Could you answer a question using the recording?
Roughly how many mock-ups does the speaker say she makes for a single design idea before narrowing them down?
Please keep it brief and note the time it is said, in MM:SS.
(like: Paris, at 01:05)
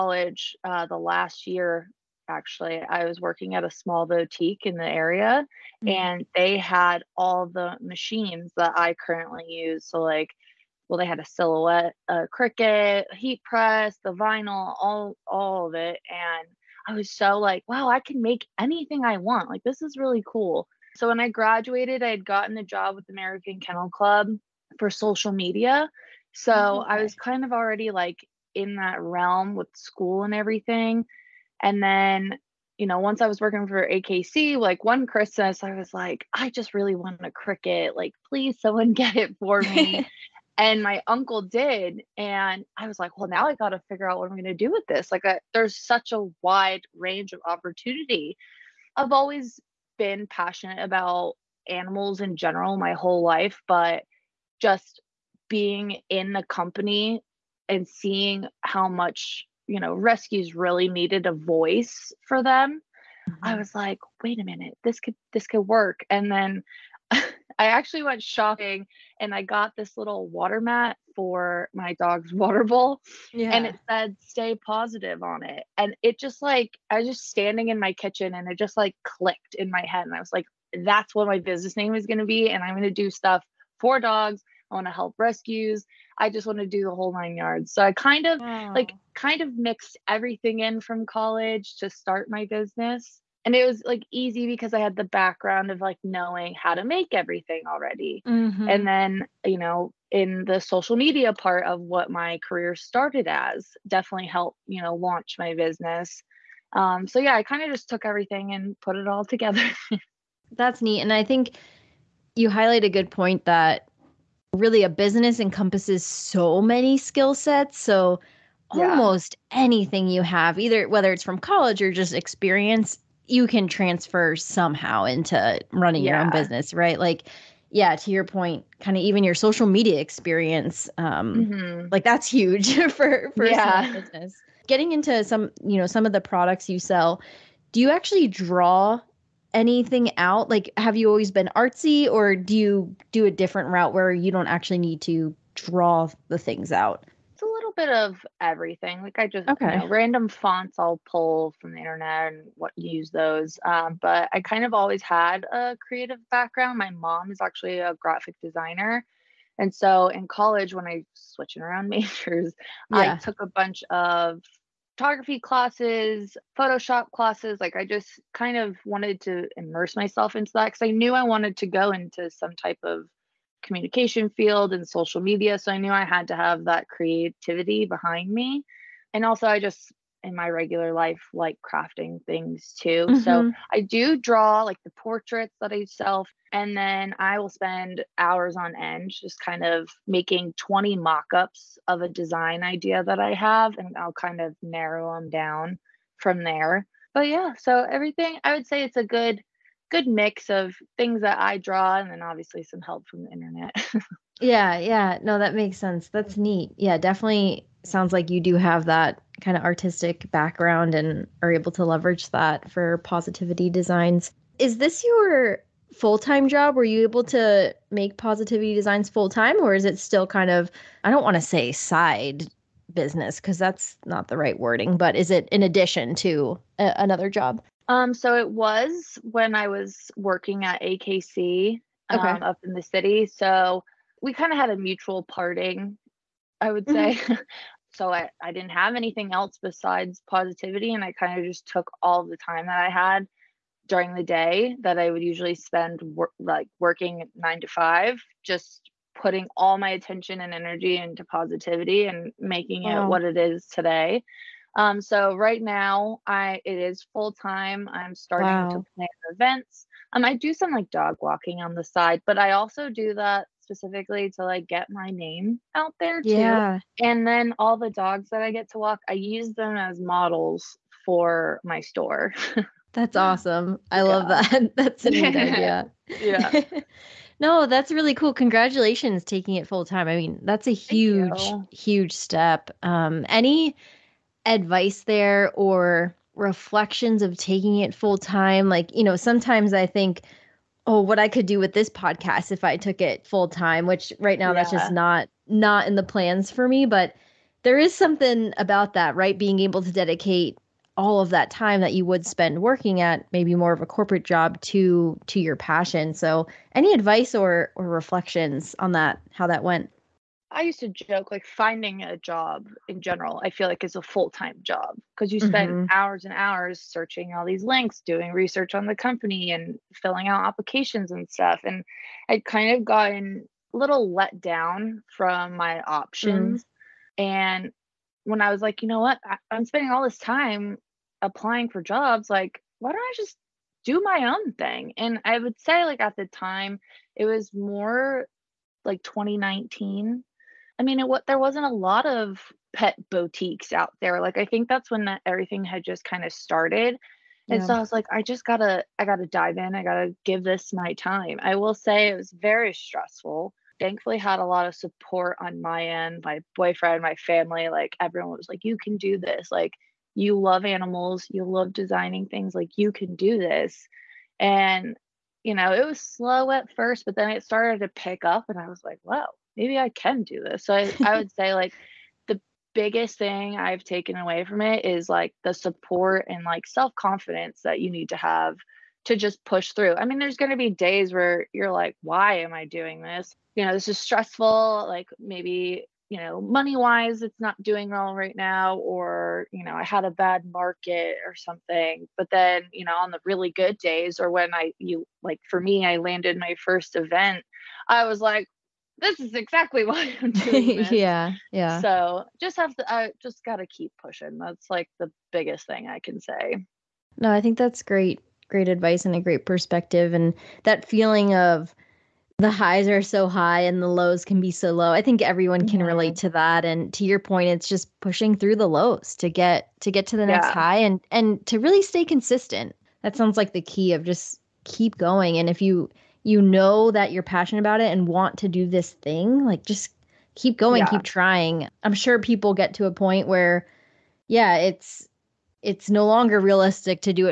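20, at 03:10.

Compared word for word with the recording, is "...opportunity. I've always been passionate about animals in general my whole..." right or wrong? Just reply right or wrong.
right.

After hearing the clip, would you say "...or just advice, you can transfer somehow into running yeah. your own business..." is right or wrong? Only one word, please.
wrong.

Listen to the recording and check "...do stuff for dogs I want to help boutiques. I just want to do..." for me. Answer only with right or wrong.
wrong.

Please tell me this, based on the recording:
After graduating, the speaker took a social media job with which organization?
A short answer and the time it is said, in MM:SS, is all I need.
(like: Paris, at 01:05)
American Kennel Club, at 00:23.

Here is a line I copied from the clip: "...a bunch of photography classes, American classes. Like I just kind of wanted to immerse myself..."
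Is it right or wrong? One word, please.
wrong.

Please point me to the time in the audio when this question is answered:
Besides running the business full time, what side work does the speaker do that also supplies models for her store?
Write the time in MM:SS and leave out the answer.
04:20.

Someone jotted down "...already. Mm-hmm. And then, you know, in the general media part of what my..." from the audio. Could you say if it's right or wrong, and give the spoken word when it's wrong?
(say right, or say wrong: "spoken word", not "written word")
wrong: "social", not "general".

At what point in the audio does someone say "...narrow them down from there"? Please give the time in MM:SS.
03:14.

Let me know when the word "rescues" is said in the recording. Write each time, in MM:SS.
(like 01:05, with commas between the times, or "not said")
00:59, 01:25.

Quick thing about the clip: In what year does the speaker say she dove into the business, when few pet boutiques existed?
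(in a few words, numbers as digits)
2019.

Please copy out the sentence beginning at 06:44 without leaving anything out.
That's like the biggest thing I can say.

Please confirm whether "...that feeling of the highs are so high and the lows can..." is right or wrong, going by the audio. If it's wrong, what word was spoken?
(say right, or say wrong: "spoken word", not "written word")
right.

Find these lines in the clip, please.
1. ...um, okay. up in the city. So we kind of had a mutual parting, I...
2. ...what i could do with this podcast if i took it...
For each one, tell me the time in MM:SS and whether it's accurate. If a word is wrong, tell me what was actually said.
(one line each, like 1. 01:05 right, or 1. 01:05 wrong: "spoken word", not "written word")
1. 03:52 right
2. 04:51 right.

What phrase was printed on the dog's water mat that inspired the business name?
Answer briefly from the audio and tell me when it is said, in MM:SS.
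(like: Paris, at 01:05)
Stay positive, at 01:14.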